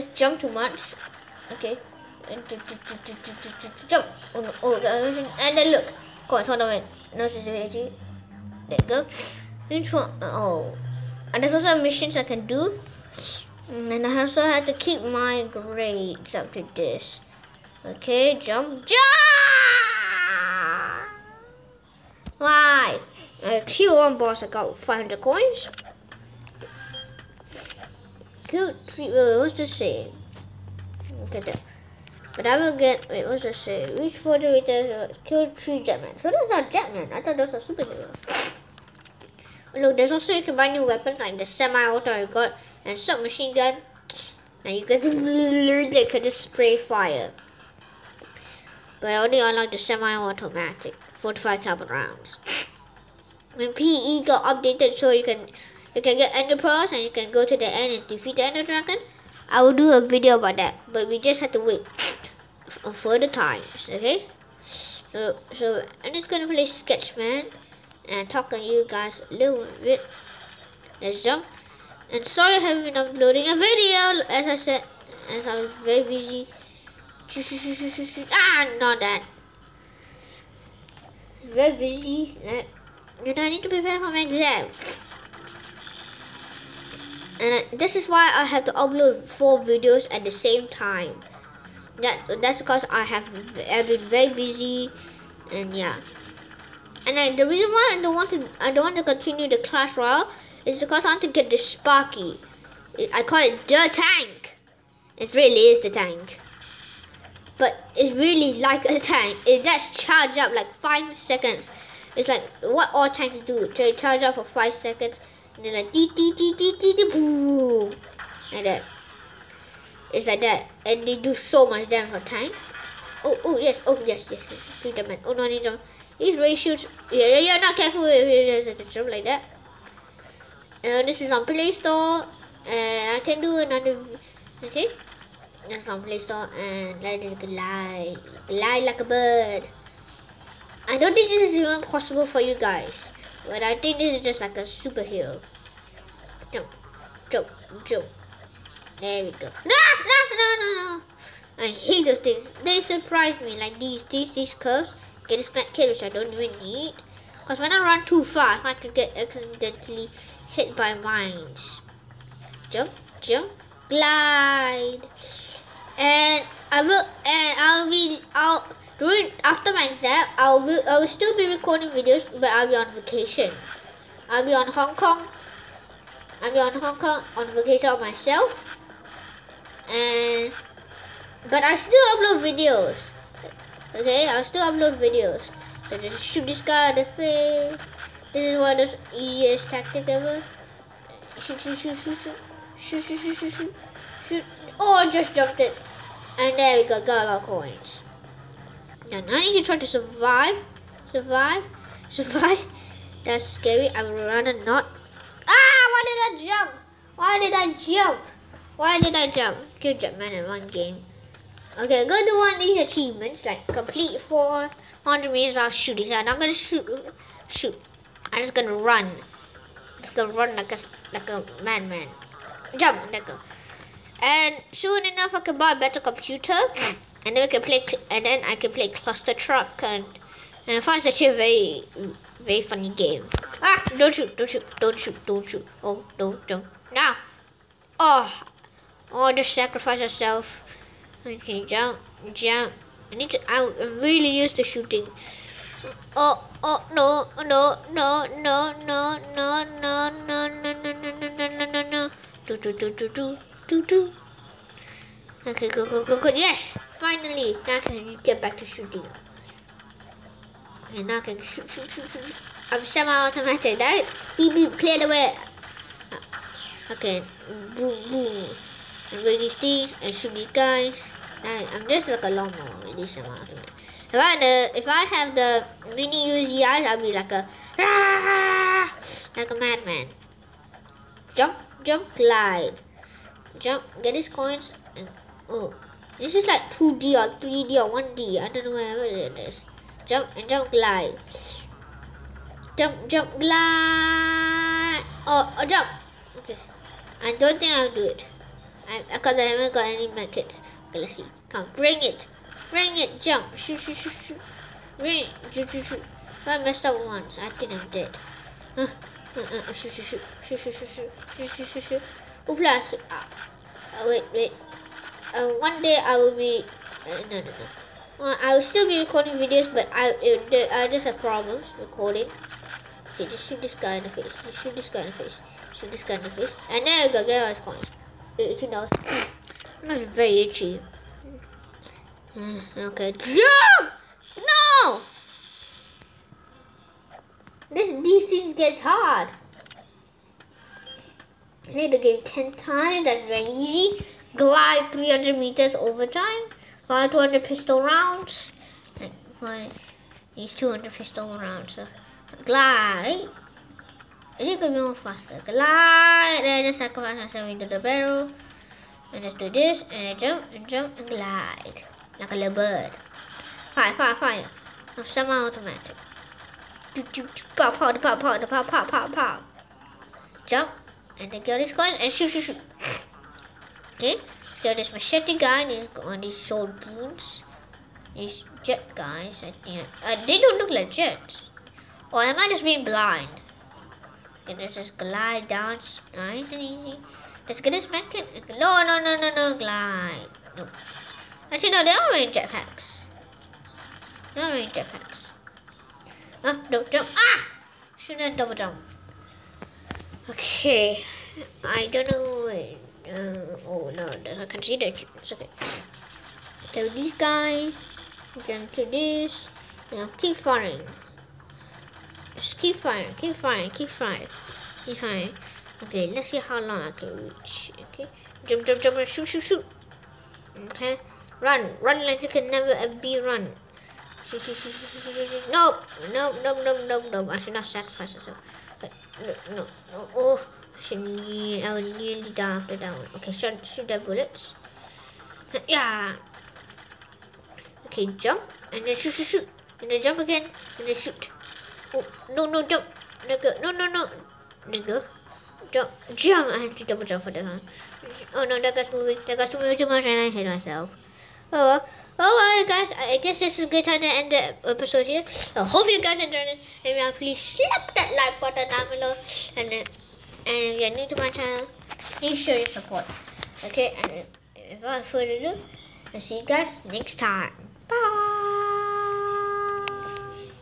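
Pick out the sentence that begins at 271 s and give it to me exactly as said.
Now, I'm just like a lawnmower this semi-automatic.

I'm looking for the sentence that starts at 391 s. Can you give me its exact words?
Actually, no, they are wearing jetpacks.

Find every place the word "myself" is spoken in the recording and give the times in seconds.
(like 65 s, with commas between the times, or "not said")
177 s, 357 s, 428 s, 450 s.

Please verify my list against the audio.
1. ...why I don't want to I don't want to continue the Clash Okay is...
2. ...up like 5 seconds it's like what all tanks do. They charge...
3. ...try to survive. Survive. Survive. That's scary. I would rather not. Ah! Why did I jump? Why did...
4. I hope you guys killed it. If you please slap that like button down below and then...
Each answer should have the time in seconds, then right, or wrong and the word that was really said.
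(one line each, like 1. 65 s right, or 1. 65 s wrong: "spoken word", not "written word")
1. 97 s wrong: "Royale", not "Okay"
2. 110 s right
3. 199 s right
4. 455 s wrong: "enjoyed", not "killed".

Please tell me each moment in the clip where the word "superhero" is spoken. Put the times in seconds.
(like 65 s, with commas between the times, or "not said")
37 s, 144 s.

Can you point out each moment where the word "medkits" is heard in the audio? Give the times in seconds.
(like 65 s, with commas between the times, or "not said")
300 s.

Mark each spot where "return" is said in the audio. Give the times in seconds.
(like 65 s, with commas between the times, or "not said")
34 s.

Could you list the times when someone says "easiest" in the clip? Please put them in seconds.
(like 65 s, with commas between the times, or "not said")
189 s.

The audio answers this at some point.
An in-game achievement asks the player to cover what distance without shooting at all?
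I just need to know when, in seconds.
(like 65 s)
214 s.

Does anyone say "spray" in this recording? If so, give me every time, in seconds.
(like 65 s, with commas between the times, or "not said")
46 s.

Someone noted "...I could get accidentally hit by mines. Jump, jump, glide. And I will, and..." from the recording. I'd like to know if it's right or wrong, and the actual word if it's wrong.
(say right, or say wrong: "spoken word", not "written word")
right.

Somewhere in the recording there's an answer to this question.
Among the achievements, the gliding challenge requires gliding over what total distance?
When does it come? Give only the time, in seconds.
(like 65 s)
344 s.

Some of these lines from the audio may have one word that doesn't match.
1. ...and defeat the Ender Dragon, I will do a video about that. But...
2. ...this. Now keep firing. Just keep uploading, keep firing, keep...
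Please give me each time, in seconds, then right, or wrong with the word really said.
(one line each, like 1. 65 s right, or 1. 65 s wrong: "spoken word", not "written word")
1. 57 s right
2. 408 s wrong: "firing", not "uploading".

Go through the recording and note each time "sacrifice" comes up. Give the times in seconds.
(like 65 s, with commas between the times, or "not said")
356 s, 427 s.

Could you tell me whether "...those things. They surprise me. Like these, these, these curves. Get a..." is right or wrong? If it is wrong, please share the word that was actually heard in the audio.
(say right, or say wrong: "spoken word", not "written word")
right.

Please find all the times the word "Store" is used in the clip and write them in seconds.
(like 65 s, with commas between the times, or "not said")
131 s, 136 s.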